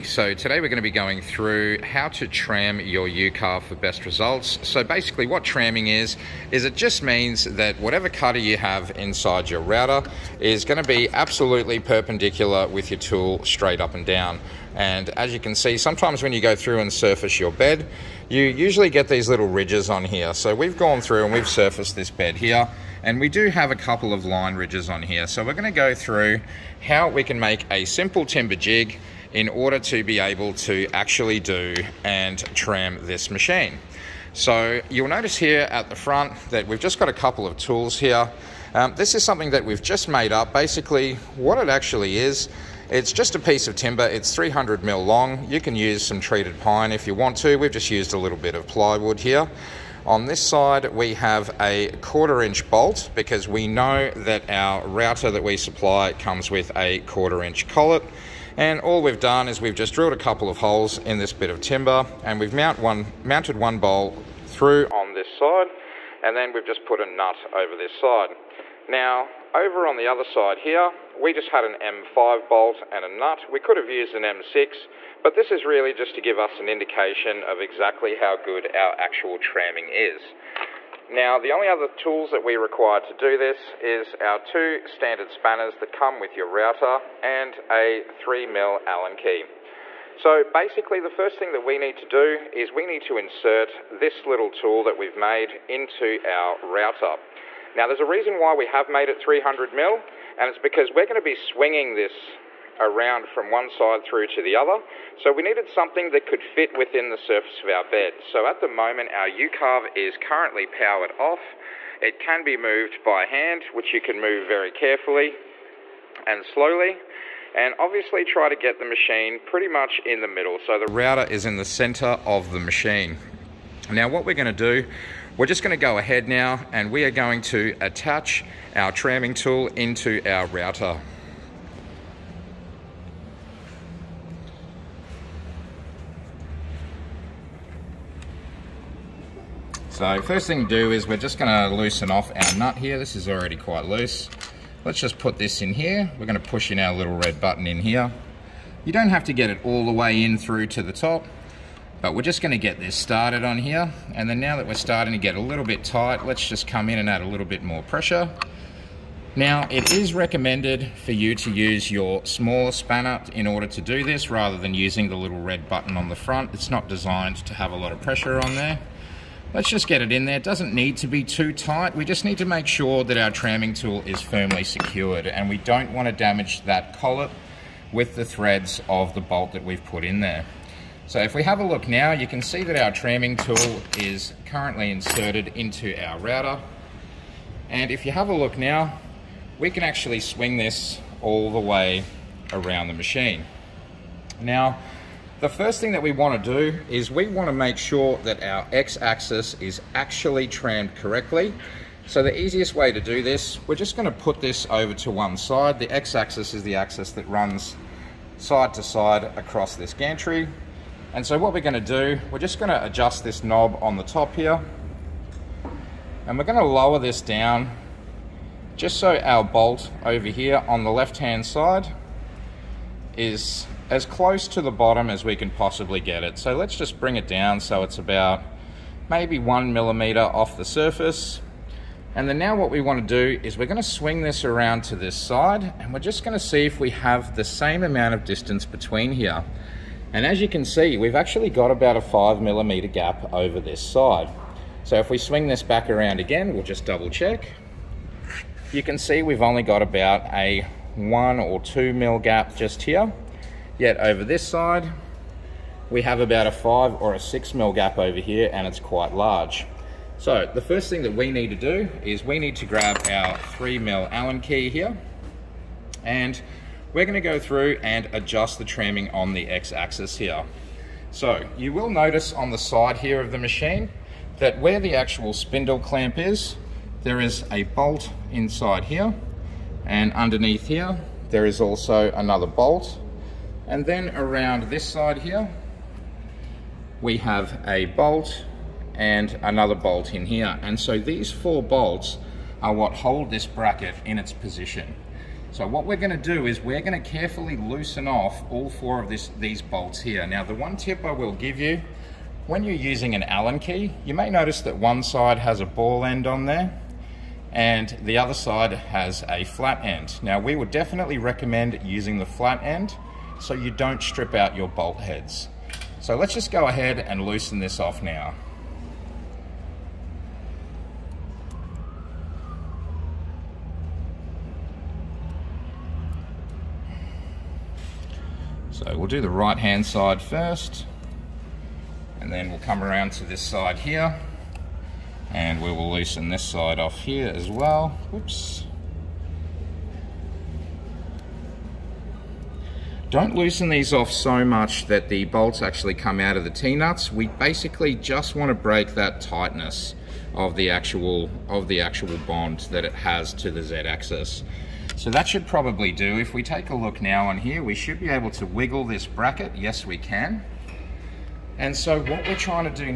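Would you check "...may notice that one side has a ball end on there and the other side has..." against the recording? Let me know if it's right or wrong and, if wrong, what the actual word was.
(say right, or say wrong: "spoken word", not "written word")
right.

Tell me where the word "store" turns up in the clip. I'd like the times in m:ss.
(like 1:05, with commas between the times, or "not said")
not said.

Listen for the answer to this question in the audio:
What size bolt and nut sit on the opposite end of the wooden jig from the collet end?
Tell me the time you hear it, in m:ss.
1:11.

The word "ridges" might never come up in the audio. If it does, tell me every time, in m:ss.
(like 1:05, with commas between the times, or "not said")
0:19, 0:24.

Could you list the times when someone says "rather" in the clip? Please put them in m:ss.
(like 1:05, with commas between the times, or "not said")
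2:44.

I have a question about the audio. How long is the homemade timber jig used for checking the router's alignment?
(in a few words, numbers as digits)
300 mm.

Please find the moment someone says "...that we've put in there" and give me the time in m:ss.
2:59.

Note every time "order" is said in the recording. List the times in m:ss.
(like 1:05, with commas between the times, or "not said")
0:29, 2:43.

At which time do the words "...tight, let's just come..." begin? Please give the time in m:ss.
2:35.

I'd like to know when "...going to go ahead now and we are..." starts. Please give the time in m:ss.
2:05.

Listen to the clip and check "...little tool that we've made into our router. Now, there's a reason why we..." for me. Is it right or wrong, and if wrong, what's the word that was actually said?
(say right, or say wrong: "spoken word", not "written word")
right.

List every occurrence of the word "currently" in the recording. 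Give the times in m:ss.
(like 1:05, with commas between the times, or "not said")
1:50, 3:04.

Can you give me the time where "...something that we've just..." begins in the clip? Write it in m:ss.
0:39.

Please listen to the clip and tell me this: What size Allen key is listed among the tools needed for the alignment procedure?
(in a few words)
3 mm.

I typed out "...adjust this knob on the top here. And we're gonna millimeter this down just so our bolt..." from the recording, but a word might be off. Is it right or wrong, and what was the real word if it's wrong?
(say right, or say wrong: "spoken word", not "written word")
wrong: "lower", not "millimeter".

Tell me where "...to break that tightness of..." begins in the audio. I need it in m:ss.
5:48.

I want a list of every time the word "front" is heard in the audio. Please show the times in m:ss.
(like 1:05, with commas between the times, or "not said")
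0:35, 2:46.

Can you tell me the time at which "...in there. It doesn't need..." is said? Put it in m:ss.
2:50.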